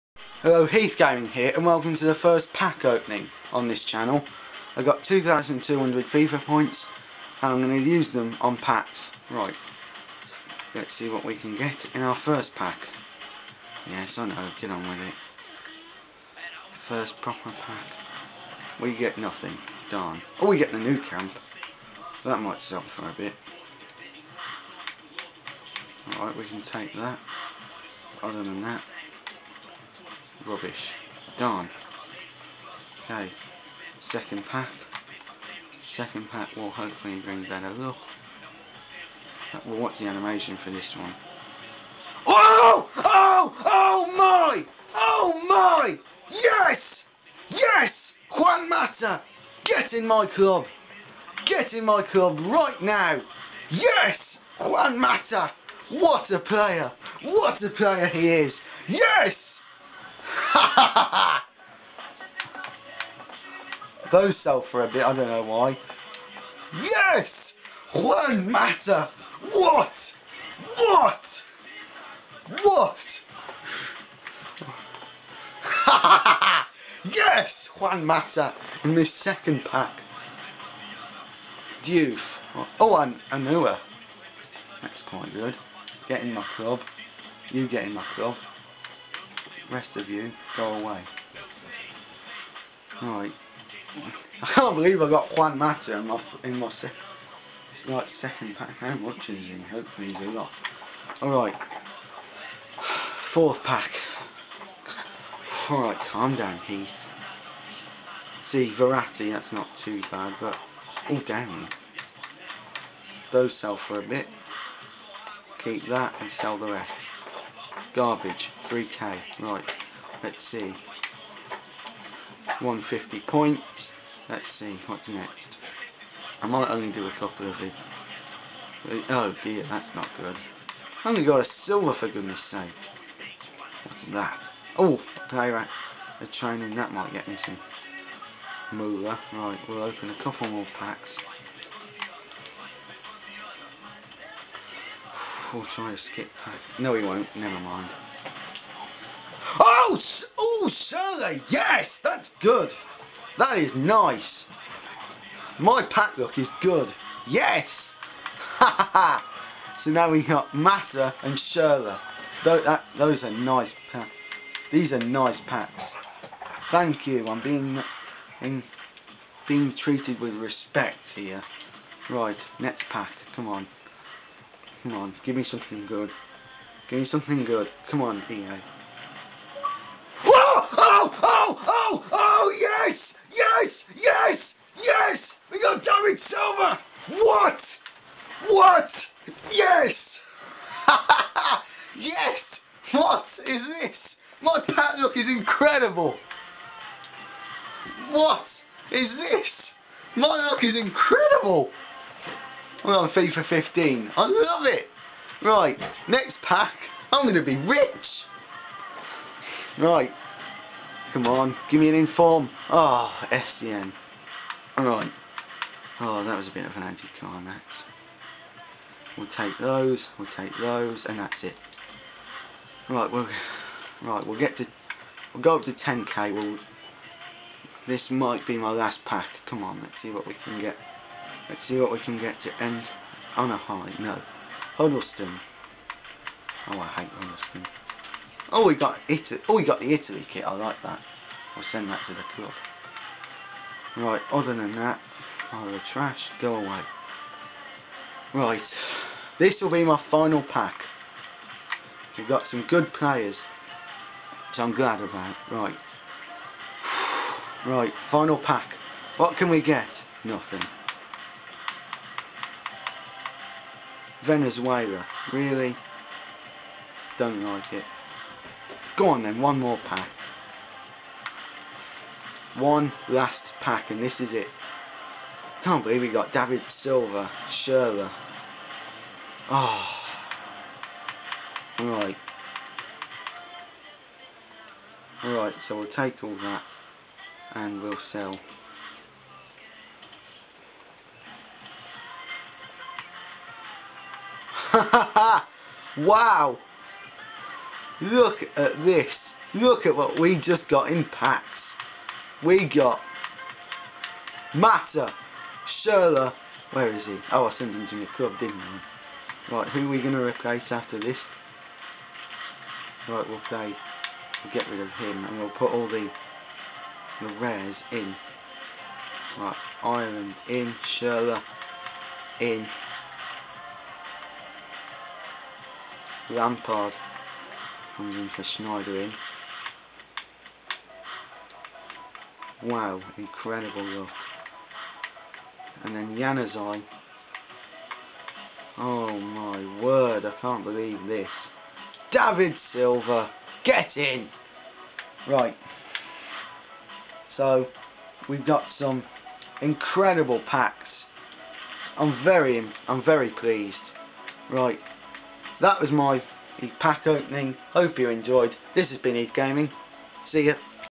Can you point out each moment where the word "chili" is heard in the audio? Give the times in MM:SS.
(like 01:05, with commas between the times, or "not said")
not said.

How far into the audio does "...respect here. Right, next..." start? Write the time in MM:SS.
02:50.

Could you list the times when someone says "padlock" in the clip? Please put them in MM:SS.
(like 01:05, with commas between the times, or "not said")
03:14.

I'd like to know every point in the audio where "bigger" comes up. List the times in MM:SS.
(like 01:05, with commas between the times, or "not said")
not said.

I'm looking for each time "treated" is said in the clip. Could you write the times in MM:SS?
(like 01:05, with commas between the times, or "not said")
02:49.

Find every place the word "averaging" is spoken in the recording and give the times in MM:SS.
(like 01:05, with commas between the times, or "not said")
not said.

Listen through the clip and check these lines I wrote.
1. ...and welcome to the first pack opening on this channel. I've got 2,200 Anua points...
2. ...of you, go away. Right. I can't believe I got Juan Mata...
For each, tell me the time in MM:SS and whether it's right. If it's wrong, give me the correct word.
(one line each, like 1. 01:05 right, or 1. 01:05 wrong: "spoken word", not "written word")
1. 00:01 wrong: "FIFA", not "Anua"
2. 01:29 right.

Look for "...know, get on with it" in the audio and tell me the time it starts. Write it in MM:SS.
00:14.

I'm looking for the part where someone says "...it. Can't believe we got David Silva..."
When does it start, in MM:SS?
04:34.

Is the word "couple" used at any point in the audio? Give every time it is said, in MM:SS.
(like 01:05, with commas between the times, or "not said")
02:07, 02:20.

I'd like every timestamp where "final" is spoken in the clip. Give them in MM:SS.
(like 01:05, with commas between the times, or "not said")
04:10, 04:18.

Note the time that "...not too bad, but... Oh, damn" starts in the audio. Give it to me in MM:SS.
01:49.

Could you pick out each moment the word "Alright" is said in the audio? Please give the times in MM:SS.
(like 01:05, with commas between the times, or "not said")
00:26, 01:41, 01:45, 03:34, 04:45.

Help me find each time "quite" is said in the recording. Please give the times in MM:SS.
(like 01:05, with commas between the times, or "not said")
01:25.